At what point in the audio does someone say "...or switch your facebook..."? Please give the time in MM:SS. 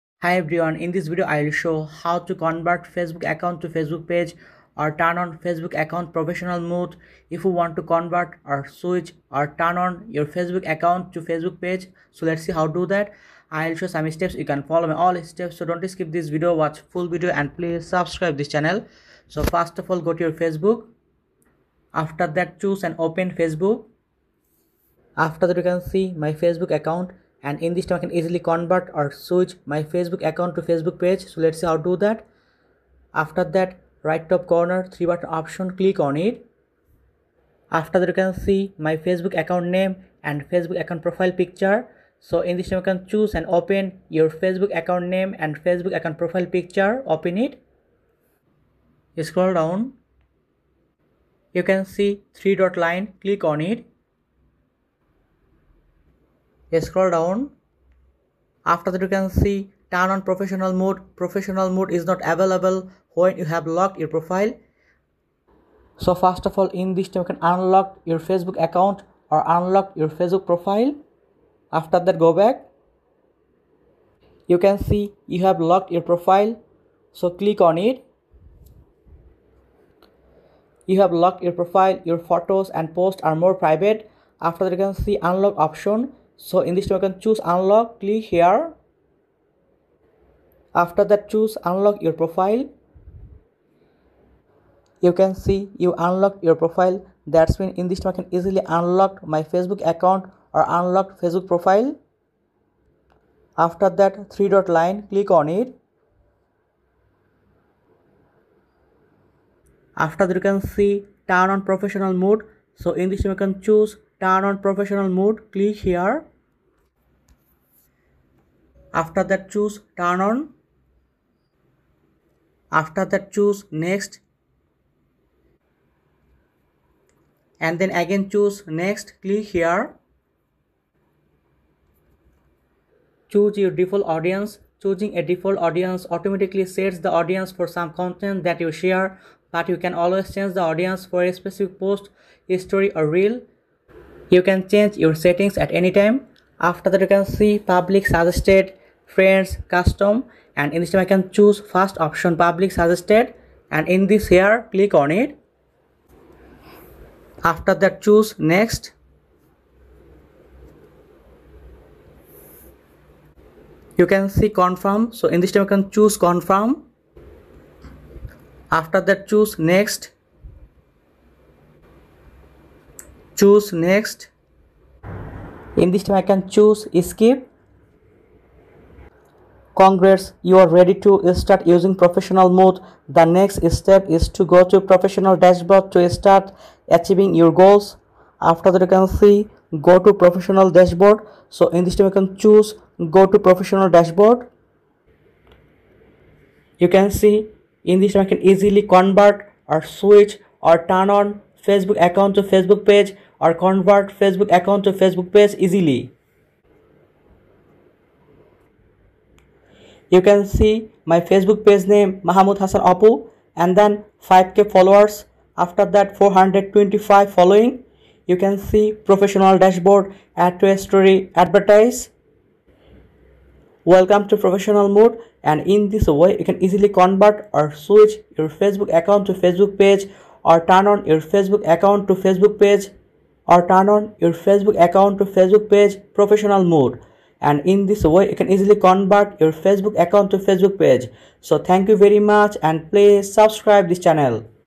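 03:47.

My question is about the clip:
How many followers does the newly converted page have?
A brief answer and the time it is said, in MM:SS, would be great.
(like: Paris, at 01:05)
5k, at 03:34.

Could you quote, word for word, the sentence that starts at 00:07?
If you want to convert or switch or turn on your Facebook account to Facebook page.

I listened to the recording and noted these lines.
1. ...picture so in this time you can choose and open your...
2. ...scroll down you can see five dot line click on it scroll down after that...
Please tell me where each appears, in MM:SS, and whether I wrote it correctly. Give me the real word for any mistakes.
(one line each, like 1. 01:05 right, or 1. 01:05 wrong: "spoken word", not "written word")
1. 00:41 right
2. 00:49 wrong: "three", not "five".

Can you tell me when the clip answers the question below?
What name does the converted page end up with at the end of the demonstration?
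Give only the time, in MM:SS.
03:32.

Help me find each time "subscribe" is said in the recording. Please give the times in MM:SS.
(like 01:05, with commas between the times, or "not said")
00:17, 04:03.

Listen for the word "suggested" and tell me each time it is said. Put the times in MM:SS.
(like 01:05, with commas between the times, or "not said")
02:28, 02:32.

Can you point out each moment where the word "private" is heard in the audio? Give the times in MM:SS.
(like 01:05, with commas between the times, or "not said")
01:23.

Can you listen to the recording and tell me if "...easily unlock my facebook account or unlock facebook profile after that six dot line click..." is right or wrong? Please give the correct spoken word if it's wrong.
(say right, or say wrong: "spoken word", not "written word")
wrong: "three", not "six".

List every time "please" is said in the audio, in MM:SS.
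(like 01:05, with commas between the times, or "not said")
00:17, 04:02.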